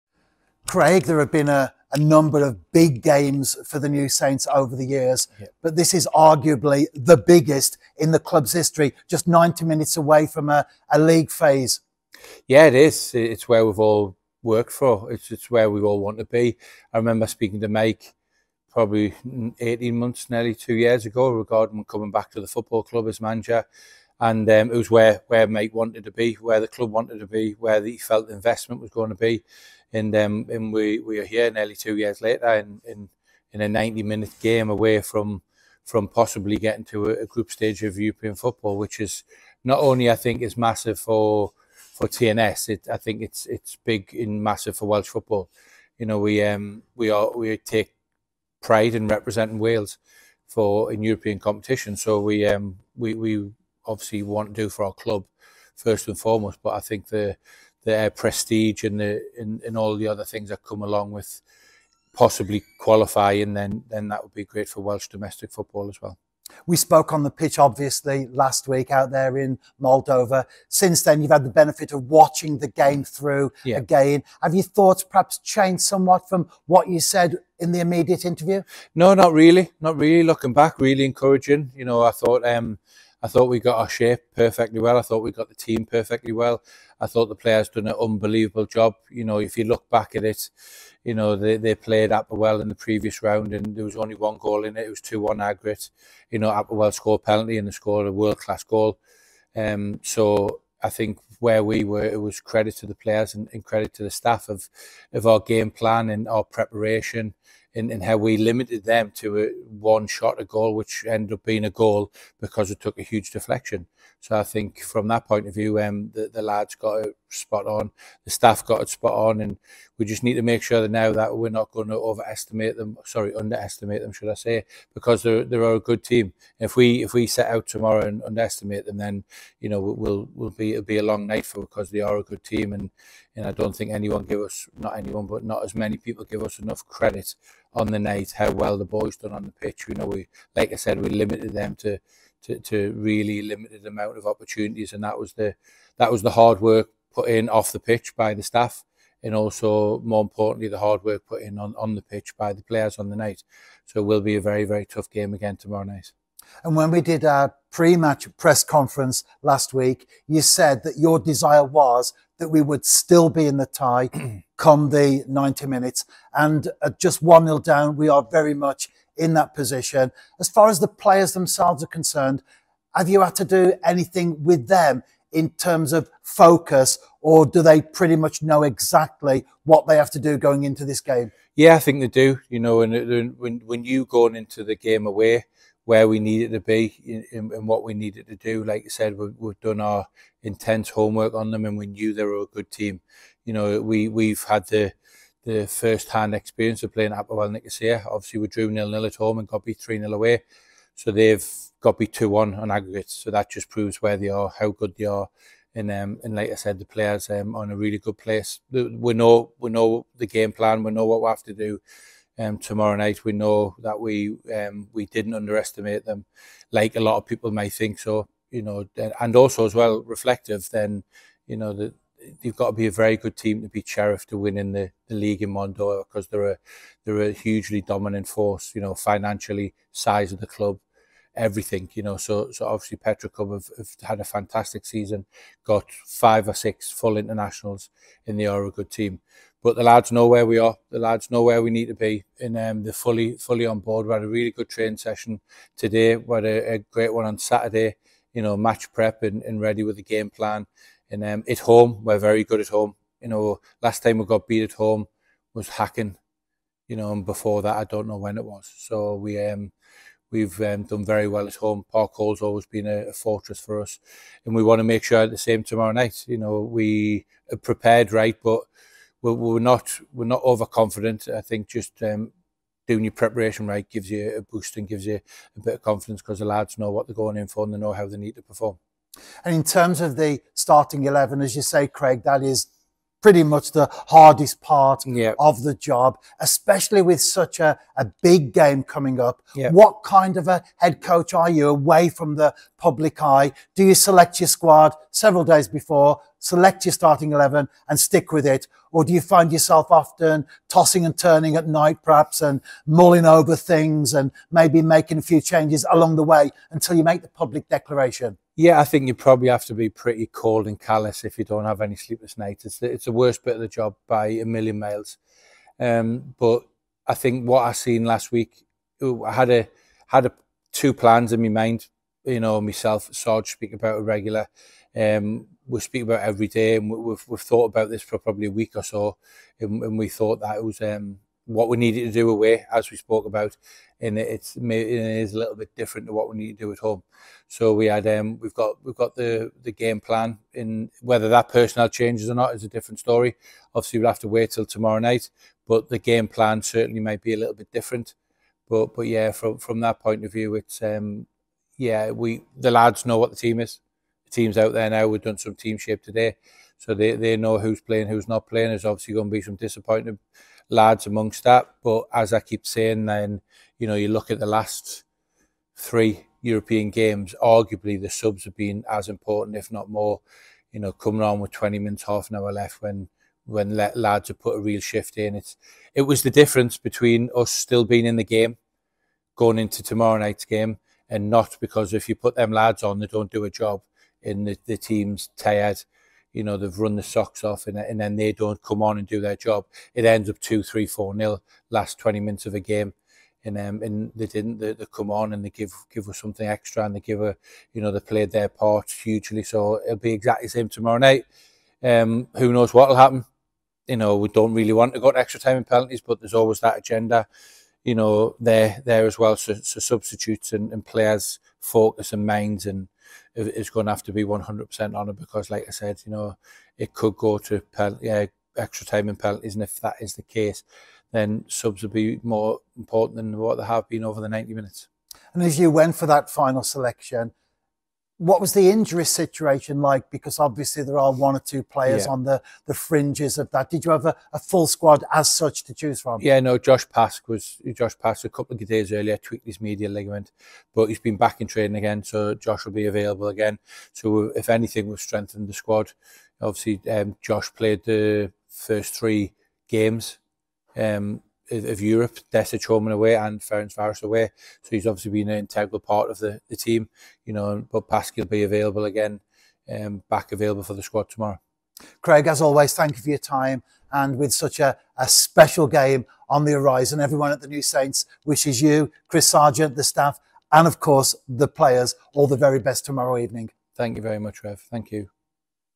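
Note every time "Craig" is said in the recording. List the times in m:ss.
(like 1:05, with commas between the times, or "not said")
0:00, 4:41, 7:42.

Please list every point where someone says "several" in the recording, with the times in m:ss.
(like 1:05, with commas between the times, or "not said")
4:55.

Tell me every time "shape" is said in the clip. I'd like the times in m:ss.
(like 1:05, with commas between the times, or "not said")
1:23, 5:55.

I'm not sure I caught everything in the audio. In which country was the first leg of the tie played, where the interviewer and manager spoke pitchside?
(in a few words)
Moldova.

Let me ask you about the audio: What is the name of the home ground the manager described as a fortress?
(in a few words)
Park Hall.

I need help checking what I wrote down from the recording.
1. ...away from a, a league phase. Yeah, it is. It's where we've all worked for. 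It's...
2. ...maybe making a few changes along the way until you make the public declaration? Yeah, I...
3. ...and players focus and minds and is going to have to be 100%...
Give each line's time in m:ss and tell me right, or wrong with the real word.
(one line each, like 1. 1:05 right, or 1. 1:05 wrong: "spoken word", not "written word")
1. 0:09 right
2. 5:04 right
3. 6:50 right.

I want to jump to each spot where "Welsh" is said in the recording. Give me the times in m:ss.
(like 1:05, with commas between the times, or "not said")
0:44, 1:04.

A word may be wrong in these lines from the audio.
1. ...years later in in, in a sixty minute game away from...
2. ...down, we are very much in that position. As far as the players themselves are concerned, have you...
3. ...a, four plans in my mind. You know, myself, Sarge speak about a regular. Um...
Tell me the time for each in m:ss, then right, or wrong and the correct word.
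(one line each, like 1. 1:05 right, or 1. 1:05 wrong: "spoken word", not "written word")
1. 0:31 wrong: "ninety", not "sixty"
2. 2:47 right
3. 5:20 wrong: "two", not "four".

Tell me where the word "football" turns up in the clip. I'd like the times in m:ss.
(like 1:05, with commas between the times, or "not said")
0:22, 0:38, 0:45, 1:05.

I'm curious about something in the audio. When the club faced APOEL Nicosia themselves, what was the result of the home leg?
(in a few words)
0-0.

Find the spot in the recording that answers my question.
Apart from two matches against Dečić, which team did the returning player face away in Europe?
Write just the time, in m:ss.
7:33.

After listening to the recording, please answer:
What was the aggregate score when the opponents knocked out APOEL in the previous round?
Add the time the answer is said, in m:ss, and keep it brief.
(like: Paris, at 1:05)
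2-1, at 1:35.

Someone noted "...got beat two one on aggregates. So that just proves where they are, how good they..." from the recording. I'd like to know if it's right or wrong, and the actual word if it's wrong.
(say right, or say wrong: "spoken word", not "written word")
right.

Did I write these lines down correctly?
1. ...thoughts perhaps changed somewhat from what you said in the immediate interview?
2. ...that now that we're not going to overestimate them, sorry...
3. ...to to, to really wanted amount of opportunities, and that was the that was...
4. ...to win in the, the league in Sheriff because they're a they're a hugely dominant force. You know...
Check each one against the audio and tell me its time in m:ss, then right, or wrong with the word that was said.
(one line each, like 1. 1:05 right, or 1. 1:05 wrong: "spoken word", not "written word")
1. 1:14 right
2. 2:00 right
3. 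2:21 wrong: "limited", not "wanted"
4. 3:44 wrong: "Mondor", not "Sheriff".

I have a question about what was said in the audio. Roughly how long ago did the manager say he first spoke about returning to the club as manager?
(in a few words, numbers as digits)
18 months.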